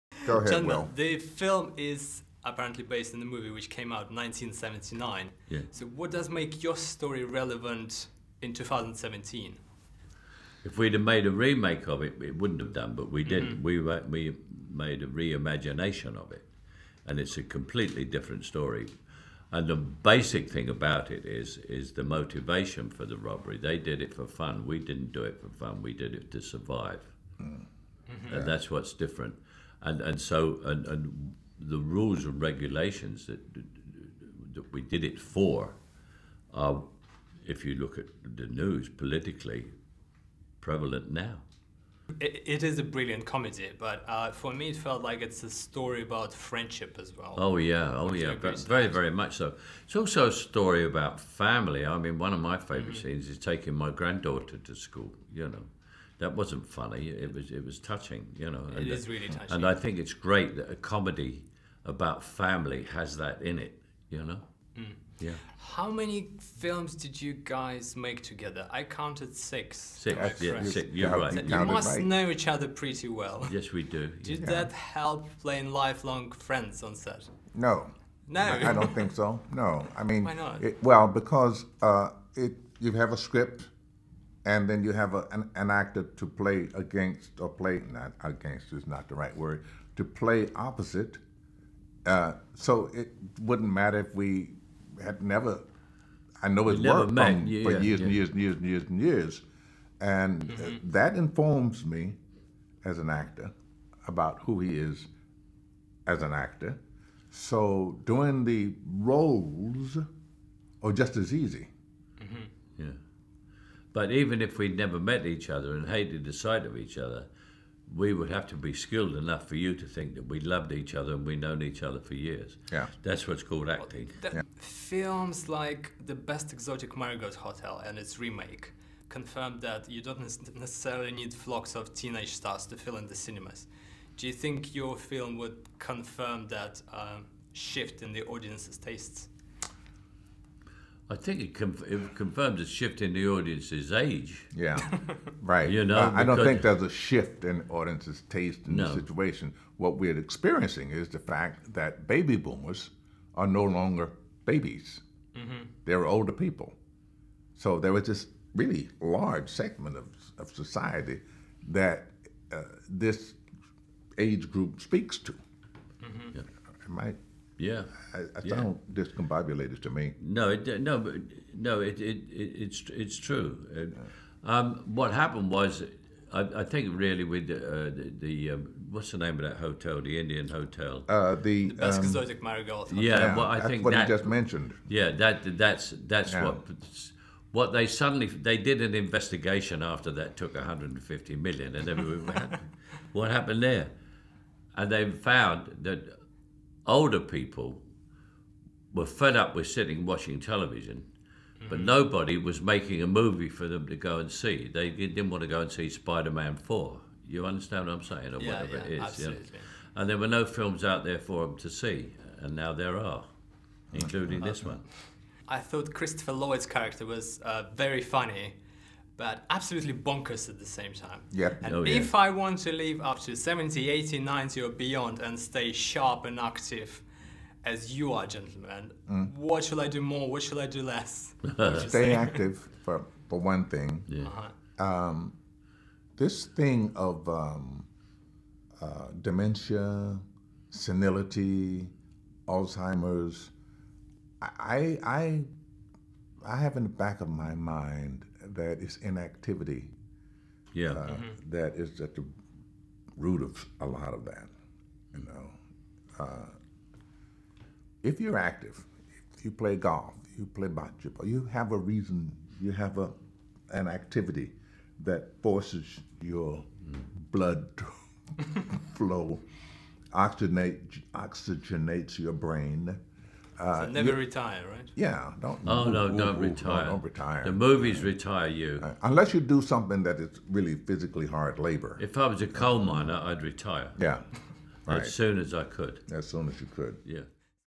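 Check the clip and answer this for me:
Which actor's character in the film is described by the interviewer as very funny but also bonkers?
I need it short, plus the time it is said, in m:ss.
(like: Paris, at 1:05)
Christopher Lloyd, at 3:35.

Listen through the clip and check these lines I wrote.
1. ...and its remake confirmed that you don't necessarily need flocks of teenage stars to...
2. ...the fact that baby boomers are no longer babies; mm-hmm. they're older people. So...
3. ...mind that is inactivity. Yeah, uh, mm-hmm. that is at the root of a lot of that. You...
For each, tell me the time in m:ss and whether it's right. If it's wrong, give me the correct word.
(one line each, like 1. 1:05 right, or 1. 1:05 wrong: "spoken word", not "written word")
1. 2:07 right
2. 2:31 right
3. 4:07 right.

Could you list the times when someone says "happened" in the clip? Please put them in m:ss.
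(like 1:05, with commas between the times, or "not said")
2:55, 3:13.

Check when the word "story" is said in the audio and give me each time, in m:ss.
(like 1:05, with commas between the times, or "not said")
0:06, 0:18, 0:45, 0:50.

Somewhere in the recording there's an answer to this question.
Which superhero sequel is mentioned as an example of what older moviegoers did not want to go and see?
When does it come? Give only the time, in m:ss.
3:25.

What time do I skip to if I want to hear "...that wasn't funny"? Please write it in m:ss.
0:56.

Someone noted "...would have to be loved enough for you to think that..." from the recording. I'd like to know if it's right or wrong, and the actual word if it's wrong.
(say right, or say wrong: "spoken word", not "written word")
wrong: "skilled", not "loved".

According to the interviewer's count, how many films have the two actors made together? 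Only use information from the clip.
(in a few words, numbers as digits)
6.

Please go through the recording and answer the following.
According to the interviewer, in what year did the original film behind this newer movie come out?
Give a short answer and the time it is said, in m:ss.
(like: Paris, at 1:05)
1979, at 0:04.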